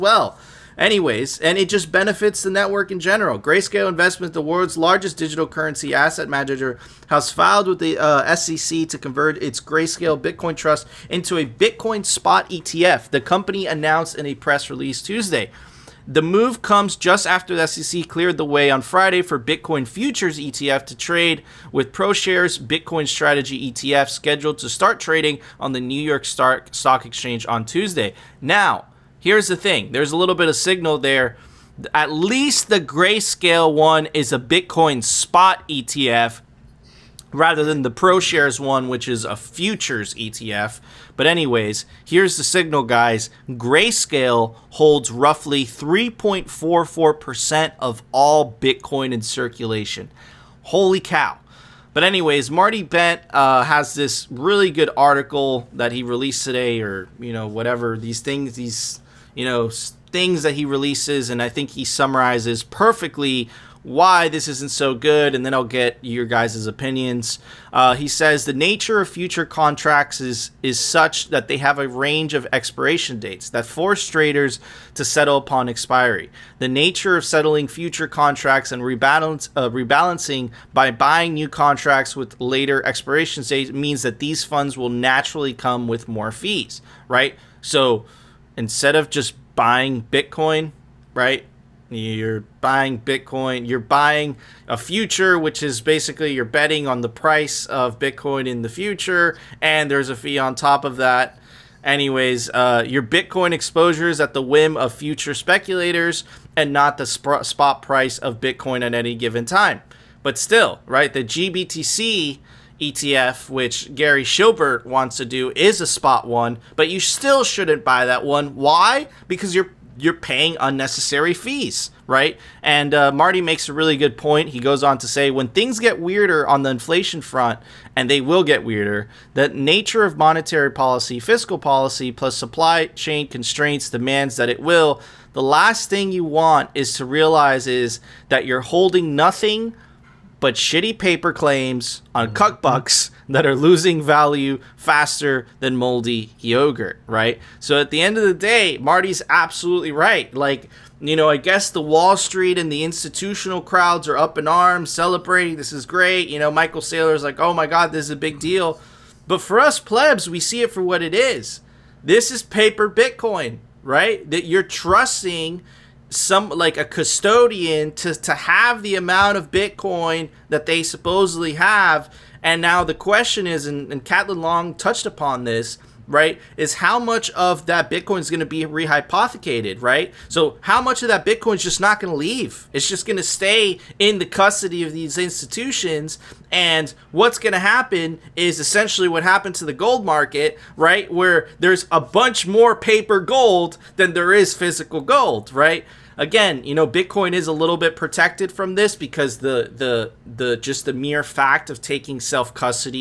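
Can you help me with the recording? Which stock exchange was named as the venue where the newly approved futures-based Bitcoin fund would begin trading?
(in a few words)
New York Stock Exchange.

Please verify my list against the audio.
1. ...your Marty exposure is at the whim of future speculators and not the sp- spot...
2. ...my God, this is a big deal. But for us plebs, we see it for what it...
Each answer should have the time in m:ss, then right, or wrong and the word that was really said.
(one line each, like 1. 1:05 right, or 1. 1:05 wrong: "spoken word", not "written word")
1. 1:42 wrong: "Bitcoin", not "Marty"
2. 2:37 right.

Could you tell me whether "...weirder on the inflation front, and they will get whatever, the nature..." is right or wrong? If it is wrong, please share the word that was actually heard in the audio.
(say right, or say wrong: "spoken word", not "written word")
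wrong: "weirder", not "whatever".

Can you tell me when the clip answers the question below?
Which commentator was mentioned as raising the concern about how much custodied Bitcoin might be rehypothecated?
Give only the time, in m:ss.
2:54.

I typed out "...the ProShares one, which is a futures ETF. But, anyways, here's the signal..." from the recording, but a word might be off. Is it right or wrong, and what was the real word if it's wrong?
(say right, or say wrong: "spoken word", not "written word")
right.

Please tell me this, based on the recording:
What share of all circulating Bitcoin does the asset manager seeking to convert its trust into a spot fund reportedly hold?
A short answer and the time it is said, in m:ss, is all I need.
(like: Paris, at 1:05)
3.44%, at 0:45.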